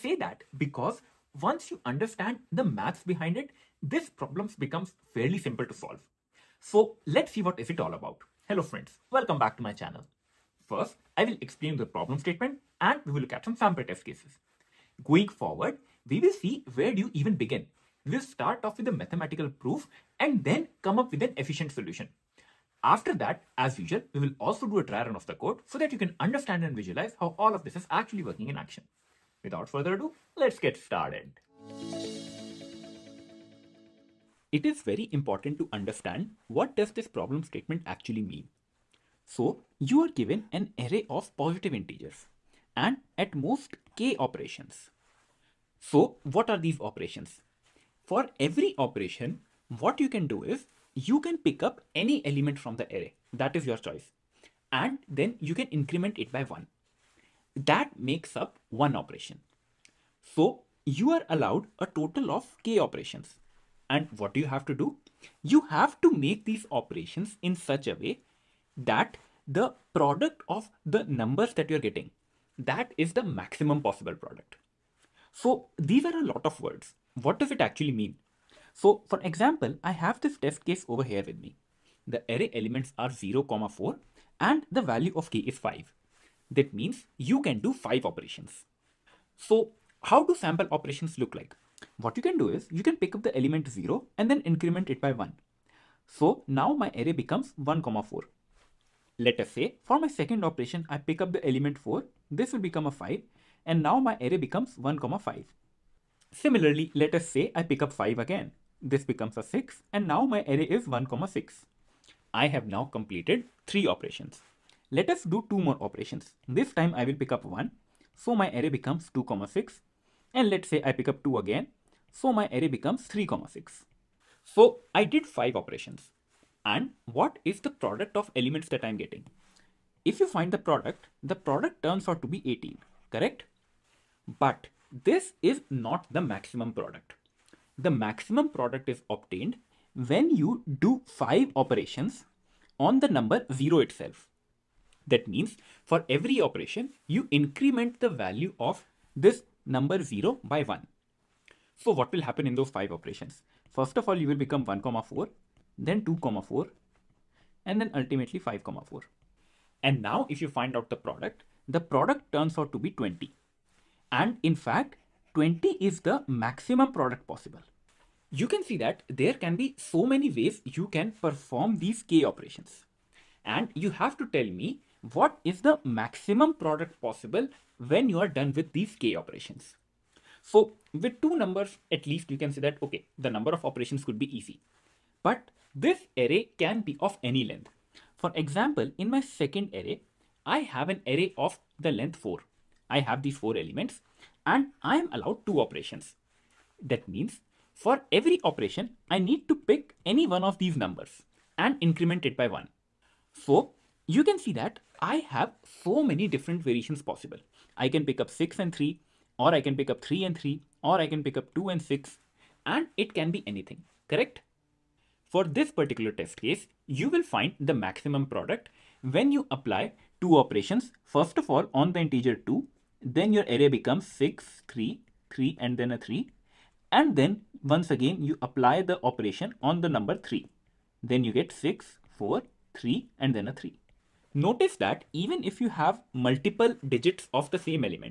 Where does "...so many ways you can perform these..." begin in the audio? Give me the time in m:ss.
2:49.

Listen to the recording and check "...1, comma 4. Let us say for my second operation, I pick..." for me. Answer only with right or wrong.
right.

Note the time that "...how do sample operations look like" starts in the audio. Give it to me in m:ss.
1:30.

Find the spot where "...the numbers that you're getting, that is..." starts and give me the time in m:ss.
1:10.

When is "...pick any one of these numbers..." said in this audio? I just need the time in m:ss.
3:19.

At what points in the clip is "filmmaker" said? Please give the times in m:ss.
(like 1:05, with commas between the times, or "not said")
not said.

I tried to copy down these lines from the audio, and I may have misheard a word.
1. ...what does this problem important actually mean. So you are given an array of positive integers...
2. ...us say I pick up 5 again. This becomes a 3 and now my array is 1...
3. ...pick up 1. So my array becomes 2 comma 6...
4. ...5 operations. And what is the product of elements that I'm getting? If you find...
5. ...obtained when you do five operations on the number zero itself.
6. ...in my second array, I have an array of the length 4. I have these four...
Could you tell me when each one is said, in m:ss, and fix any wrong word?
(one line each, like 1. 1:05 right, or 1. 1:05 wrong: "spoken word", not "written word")
1. 0:36 wrong: "statement", not "important"
2. 1:47 wrong: "6", not "3"
3. 1:57 right
4. 2:05 right
5. 2:19 right
6. 3:08 right.